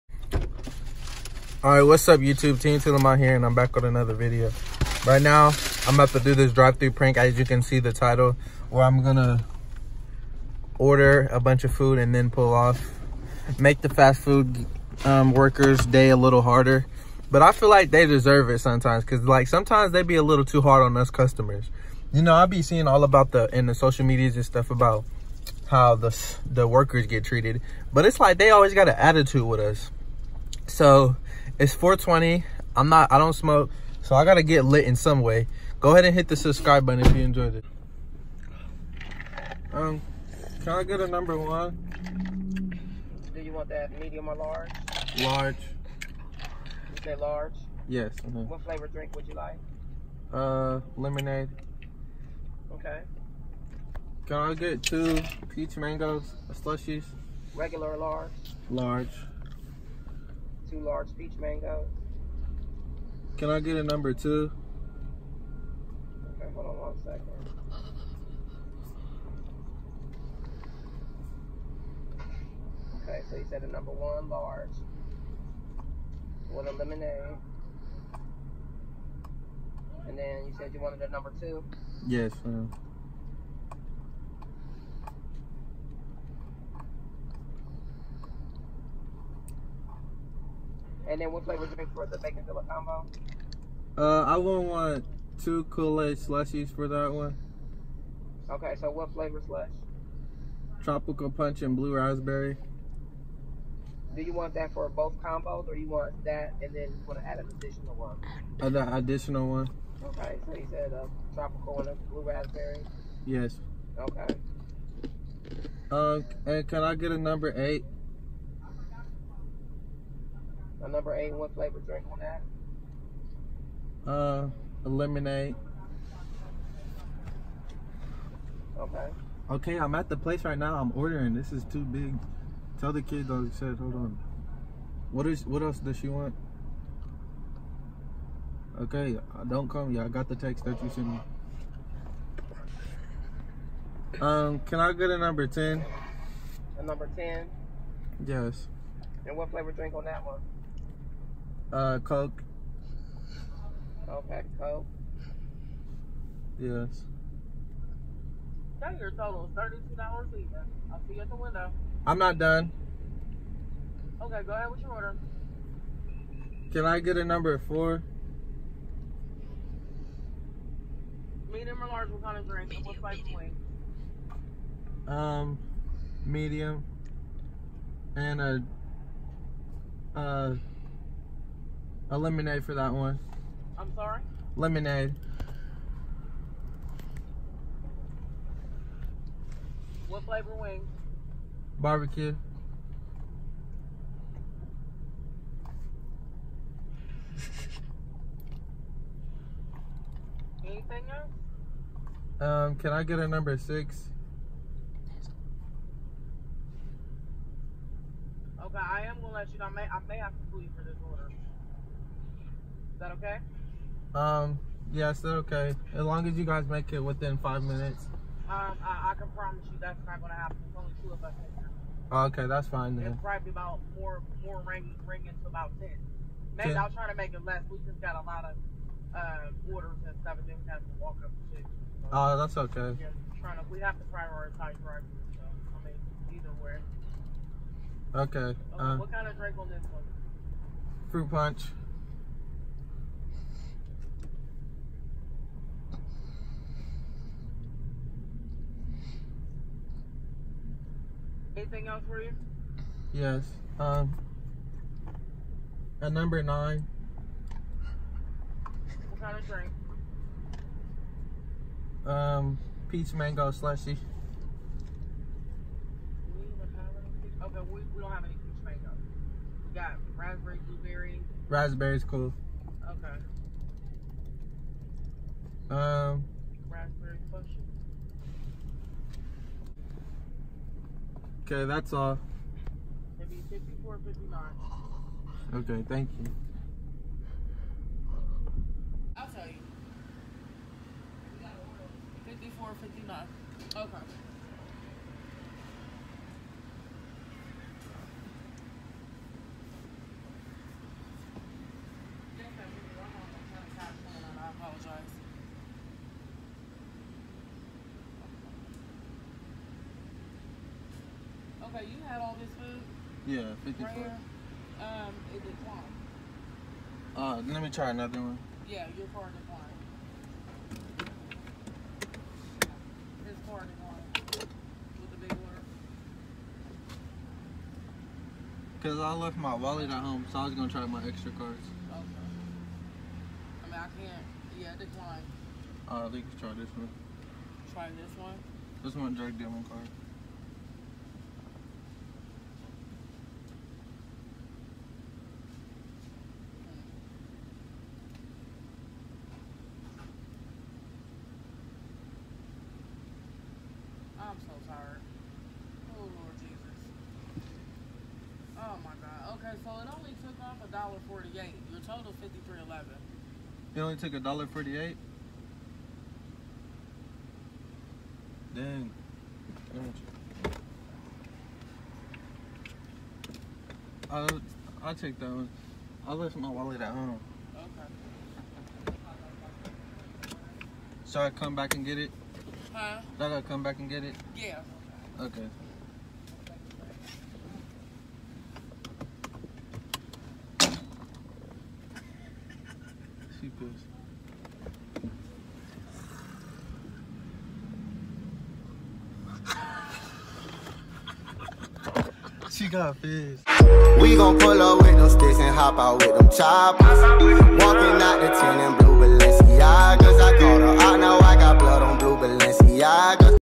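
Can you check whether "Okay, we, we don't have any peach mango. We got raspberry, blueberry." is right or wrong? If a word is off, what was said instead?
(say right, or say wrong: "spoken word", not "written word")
right.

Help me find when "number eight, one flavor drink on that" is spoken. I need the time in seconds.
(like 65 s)
120 s.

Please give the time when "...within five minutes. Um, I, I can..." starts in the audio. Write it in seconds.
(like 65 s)
217 s.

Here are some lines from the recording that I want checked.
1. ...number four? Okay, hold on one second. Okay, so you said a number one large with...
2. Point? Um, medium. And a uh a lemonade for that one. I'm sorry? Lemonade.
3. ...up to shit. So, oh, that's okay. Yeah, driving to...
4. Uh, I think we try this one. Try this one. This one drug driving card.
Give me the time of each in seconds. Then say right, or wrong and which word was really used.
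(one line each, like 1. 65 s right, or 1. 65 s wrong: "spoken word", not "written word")
1. 63 s wrong: "two", not "four"
2. 173 s right
3. 231 s wrong: "trying", not "driving"
4. 335 s wrong: "dealing", not "driving".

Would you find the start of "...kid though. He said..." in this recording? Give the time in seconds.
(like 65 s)
133 s.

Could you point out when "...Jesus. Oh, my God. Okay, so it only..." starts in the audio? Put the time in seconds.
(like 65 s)
356 s.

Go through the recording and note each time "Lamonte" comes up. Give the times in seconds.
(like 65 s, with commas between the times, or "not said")
2 s.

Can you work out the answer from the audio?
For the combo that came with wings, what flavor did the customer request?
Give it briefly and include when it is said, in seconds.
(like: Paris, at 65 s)
Barbecue, at 191 s.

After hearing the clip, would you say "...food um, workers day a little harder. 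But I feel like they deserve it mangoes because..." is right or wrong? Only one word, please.
wrong.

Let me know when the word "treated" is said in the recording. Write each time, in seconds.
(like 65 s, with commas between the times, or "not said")
27 s.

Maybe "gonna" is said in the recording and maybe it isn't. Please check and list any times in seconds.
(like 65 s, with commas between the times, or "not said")
9 s, 209 s, 220 s, 330 s.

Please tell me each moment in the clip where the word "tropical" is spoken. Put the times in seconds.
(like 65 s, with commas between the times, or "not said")
100 s, 111 s.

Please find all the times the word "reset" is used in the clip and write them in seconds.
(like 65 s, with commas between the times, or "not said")
not said.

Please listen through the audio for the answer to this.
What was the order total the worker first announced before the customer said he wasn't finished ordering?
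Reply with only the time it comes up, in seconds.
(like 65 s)
159 s.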